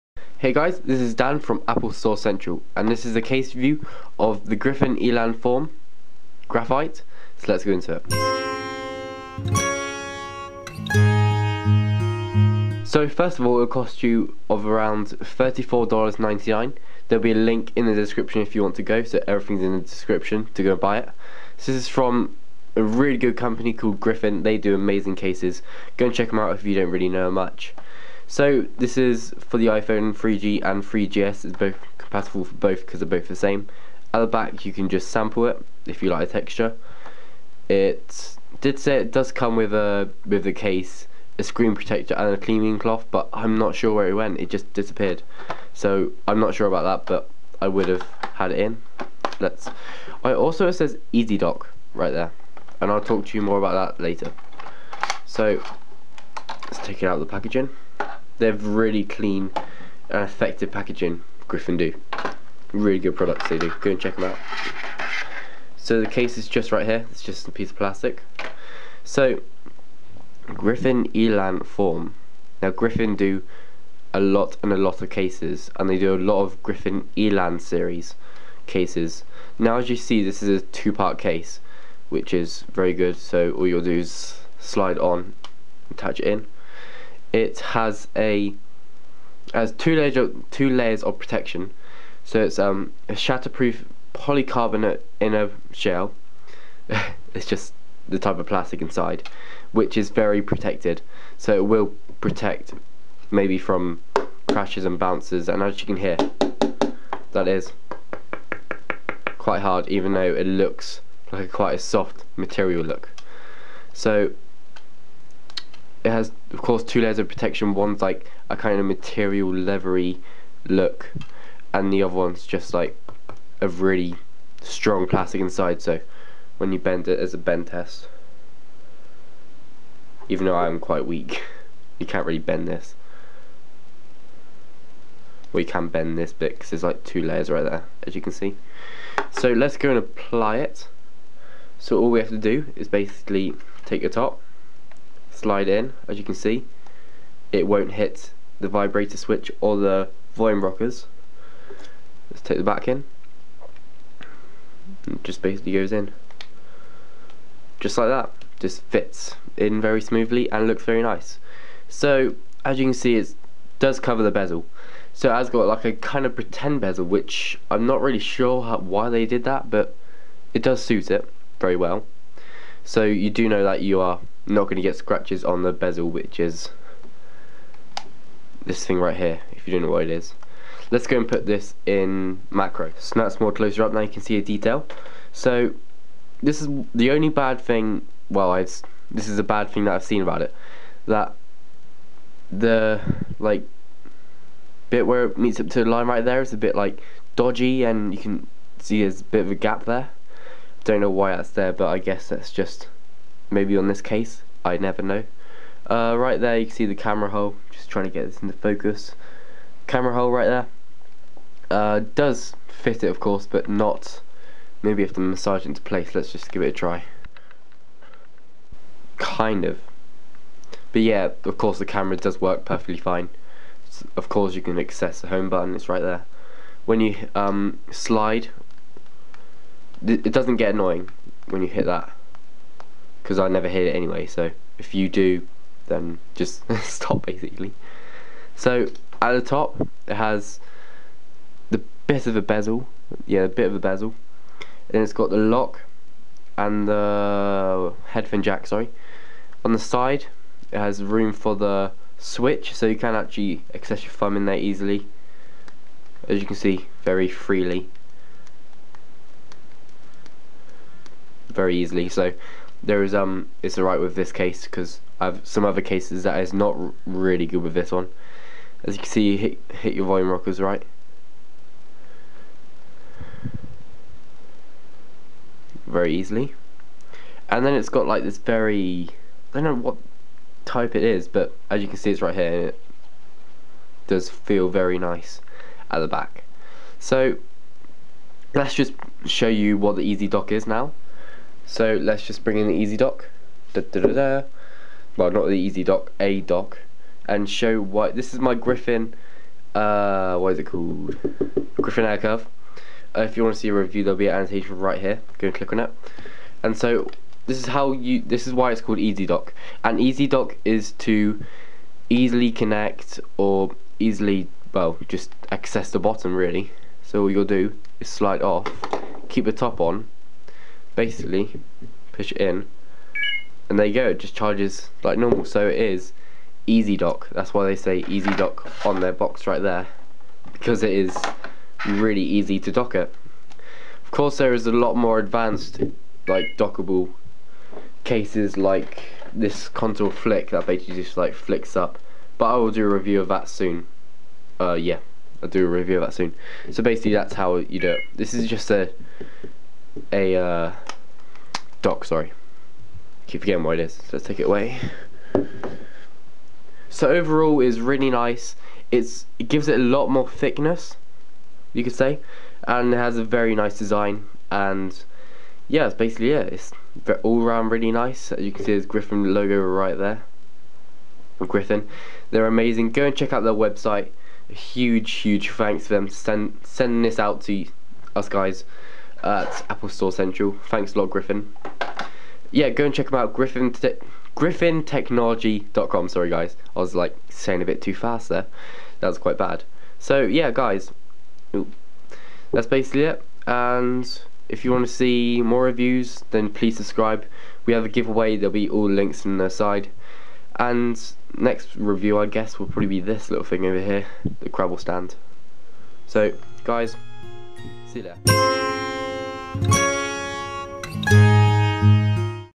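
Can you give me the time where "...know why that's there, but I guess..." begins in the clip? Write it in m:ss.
3:21.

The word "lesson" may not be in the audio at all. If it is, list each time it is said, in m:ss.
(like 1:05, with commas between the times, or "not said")
not said.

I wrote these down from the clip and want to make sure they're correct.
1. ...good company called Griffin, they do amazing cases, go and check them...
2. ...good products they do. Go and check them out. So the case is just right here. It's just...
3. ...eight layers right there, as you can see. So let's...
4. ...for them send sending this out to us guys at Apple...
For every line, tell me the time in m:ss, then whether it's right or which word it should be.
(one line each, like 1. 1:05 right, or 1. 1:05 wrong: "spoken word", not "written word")
1. 0:23 right
2. 1:02 right
3. 2:17 wrong: "two", not "eight"
4. 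6:15 right.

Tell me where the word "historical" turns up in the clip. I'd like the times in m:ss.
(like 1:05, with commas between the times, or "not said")
not said.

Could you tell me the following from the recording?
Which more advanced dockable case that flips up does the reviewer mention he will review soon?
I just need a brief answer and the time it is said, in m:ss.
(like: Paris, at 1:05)
Contour Flick, at 5:39.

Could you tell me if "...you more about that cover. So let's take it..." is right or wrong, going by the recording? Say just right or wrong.
wrong.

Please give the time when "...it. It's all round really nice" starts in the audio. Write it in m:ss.
6:06.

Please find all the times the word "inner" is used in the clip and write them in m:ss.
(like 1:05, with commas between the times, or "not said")
1:35.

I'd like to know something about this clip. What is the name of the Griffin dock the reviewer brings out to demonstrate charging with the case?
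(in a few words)
Griffin AirCurve.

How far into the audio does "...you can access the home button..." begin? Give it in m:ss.
3:44.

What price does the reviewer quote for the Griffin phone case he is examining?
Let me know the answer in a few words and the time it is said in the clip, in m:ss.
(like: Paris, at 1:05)
$34.99, at 0:15.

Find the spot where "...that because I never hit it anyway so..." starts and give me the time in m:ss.
3:51.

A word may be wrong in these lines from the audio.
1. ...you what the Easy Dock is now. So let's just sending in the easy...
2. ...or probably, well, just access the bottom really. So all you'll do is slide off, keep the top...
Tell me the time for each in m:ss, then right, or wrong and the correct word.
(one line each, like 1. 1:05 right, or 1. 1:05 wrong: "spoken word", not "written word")
1. 4:49 wrong: "bring", not "sending"
2. 5:13 wrong: "easily", not "probably".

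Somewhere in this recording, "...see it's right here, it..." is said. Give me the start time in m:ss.
4:41.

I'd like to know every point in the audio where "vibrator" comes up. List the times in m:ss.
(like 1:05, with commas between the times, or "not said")
2:28.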